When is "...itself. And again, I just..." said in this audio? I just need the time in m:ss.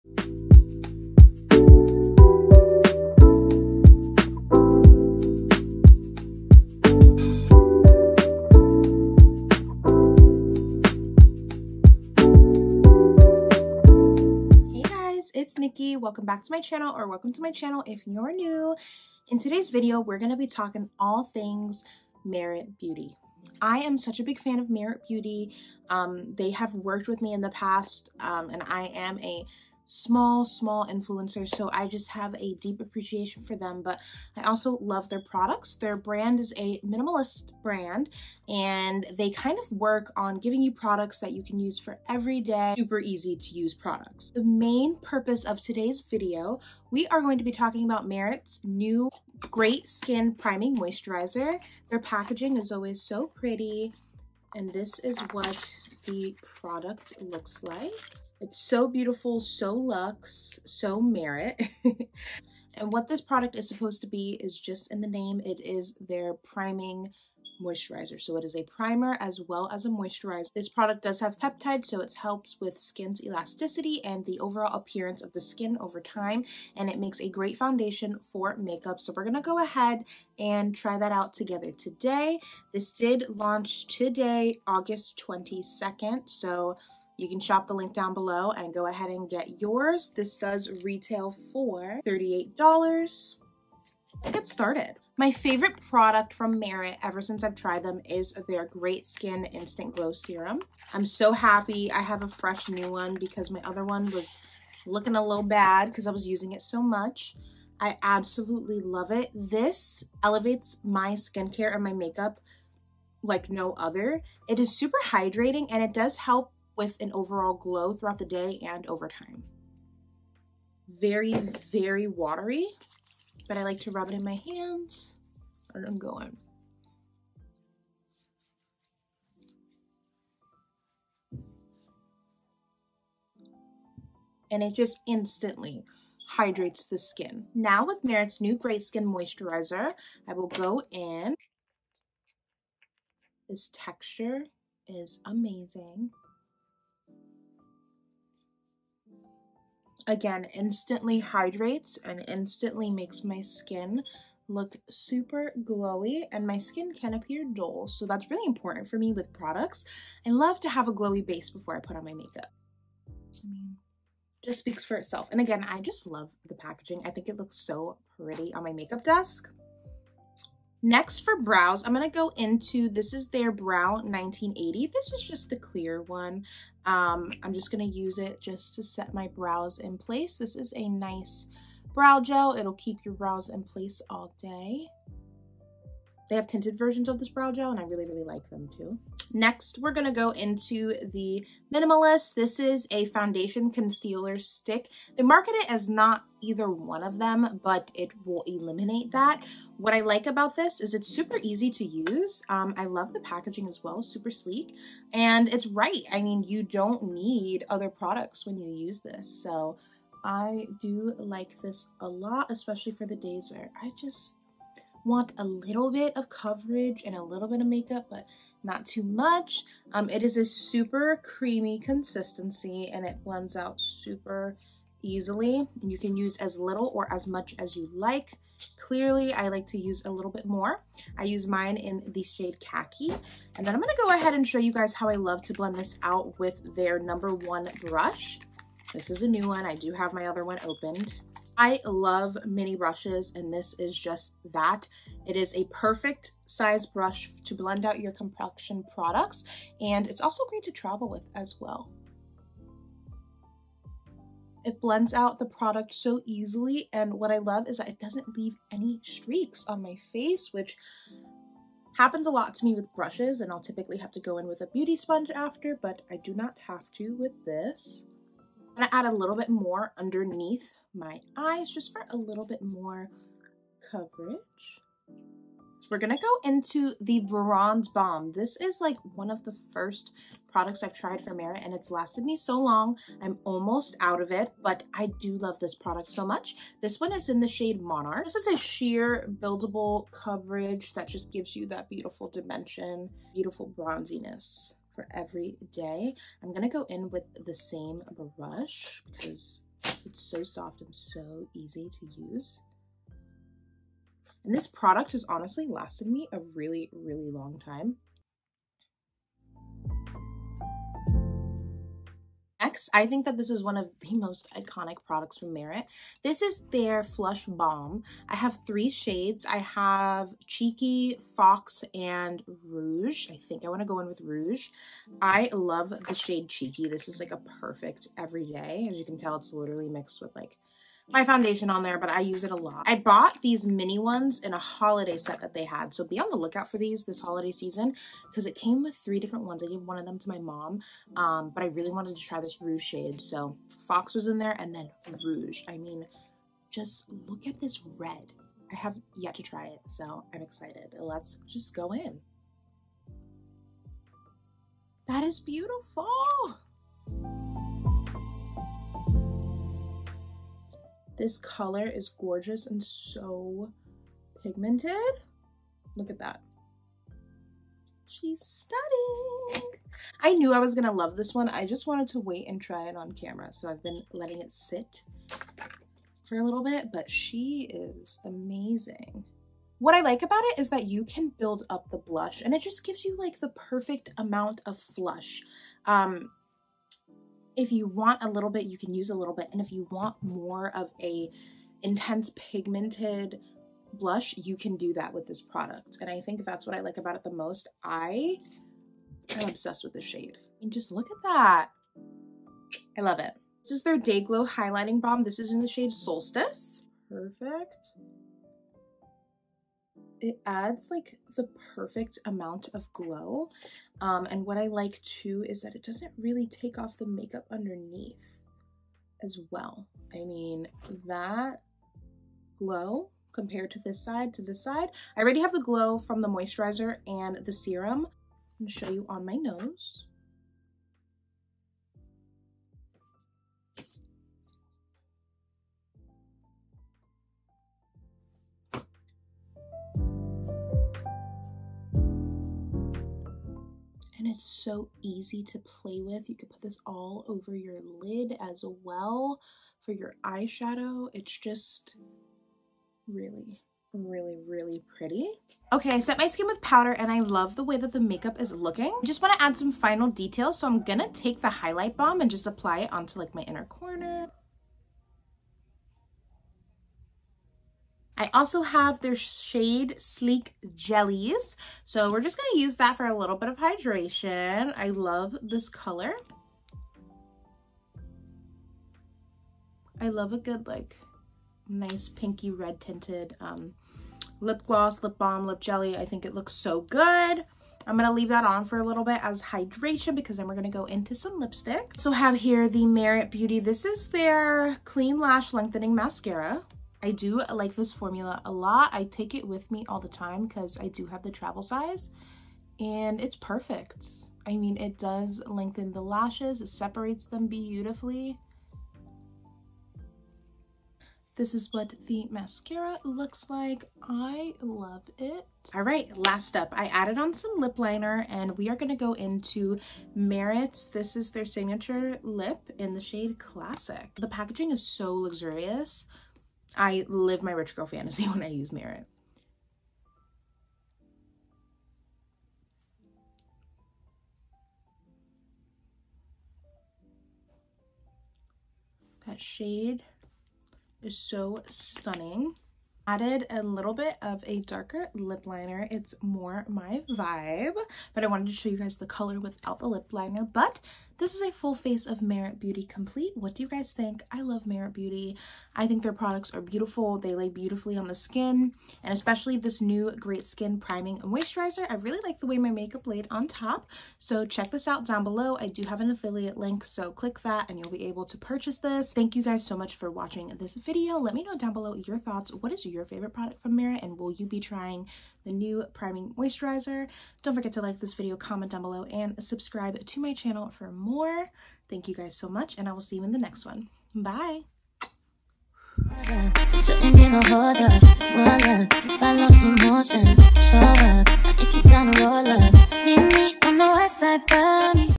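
2:44.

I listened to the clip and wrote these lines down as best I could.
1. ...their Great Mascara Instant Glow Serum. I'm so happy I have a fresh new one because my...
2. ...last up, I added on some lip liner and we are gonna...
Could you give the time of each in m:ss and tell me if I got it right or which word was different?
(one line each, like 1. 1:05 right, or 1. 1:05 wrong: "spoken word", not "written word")
1. 1:38 wrong: "Skin", not "Mascara"
2. 8:36 right.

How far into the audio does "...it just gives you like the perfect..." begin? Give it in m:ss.
6:22.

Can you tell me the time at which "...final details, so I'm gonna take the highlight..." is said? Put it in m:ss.
7:39.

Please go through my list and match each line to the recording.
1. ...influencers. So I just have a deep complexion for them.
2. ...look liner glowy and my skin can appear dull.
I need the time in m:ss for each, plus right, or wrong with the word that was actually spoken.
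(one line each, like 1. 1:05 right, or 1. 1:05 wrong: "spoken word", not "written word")
1. 0:30 wrong: "appreciation", not "complexion"
2. 2:34 wrong: "super", not "liner".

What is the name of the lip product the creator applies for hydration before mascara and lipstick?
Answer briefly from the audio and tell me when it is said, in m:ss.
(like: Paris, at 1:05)
Shade Slick Jellies, at 7:49.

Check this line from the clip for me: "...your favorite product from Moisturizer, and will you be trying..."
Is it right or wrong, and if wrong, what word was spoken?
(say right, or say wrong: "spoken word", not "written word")
wrong: "Merit", not "Moisturizer".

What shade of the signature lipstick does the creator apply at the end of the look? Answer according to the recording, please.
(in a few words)
Classic.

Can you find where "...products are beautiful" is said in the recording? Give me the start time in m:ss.
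9:16.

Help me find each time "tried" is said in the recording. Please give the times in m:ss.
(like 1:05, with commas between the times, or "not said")
1:37, 4:40.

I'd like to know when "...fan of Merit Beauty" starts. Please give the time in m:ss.
0:24.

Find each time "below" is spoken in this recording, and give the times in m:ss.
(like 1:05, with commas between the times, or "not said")
1:28, 9:25, 9:31, 9:38.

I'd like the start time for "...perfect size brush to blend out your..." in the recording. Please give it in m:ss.
4:05.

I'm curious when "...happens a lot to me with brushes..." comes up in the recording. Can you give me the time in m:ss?
4:21.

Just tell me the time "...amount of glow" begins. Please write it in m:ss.
6:52.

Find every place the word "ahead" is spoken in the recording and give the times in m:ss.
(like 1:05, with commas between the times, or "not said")
1:19, 1:28, 3:54.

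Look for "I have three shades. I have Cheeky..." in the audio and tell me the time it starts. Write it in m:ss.
5:18.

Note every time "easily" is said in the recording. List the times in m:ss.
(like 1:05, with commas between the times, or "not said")
3:45, 4:16.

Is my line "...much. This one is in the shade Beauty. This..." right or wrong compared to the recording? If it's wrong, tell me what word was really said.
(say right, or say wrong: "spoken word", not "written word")
wrong: "Monarch", not "Beauty".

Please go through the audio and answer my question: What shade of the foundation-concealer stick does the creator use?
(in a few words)
Khaki.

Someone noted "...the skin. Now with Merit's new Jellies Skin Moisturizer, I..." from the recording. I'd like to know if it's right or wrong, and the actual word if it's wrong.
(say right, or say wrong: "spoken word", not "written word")
wrong: "Great", not "Jellies".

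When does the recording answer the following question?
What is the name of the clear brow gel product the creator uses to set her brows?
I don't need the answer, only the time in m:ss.
2:53.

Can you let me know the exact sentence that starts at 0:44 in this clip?
The main purpose of today's video, we are going to be talking about Merit's new Great Skin Priming Moisturizer.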